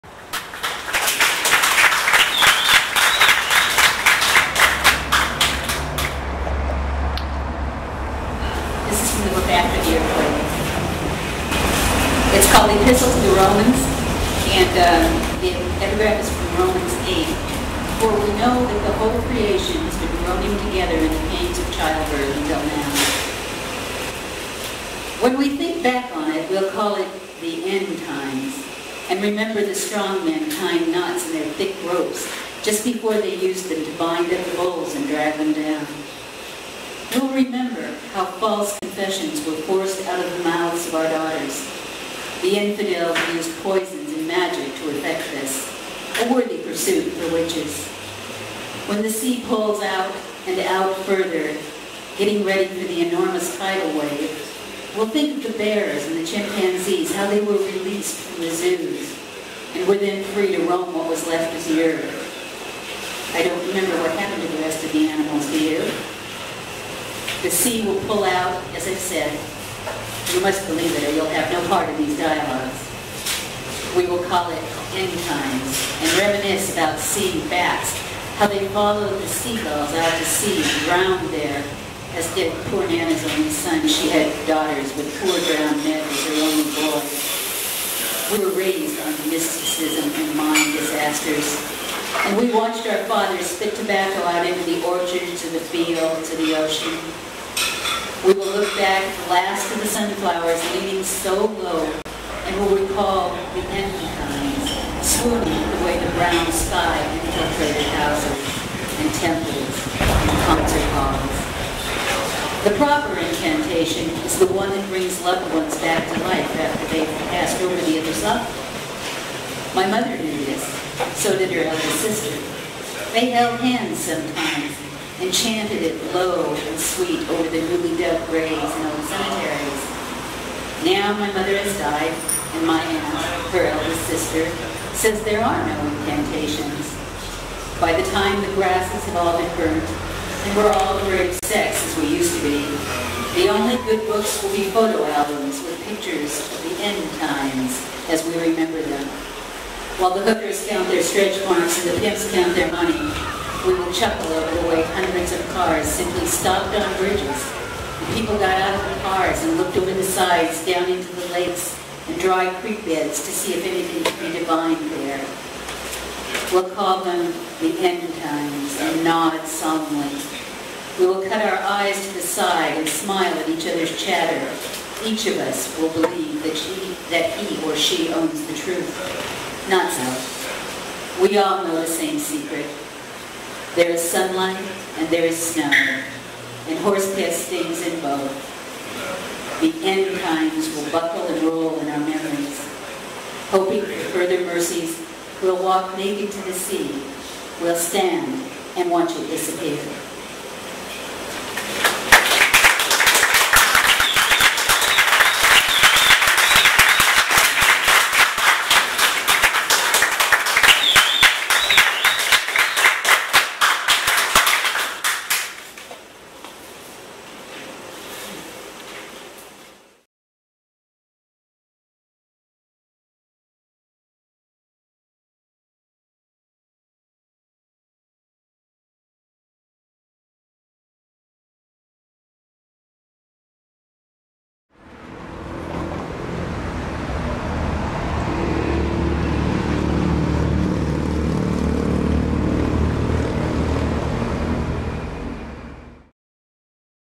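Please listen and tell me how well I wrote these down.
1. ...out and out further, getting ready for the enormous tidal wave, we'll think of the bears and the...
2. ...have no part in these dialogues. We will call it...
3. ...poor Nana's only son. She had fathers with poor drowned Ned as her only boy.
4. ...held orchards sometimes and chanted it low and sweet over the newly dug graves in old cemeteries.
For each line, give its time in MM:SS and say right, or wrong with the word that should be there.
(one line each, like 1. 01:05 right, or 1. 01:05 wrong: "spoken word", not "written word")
1. 00:49 right
2. 01:11 right
3. 01:22 wrong: "daughters", not "fathers"
4. 02:03 wrong: "hands", not "orchards".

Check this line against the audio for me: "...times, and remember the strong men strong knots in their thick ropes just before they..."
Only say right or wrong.
wrong.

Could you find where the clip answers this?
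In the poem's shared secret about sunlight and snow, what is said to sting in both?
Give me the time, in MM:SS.
03:06.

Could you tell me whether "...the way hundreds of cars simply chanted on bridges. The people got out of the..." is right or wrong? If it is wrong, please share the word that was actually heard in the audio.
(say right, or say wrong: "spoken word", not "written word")
wrong: "stopped", not "chanted".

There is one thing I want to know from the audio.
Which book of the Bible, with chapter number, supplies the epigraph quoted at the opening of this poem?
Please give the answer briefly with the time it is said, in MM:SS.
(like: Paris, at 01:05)
Romans 8, at 00:16.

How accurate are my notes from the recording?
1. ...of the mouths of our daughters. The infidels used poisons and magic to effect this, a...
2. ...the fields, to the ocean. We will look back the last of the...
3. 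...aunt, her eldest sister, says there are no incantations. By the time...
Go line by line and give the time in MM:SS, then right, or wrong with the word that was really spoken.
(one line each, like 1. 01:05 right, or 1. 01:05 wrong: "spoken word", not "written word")
1. 00:40 right
2. 01:35 right
3. 02:12 right.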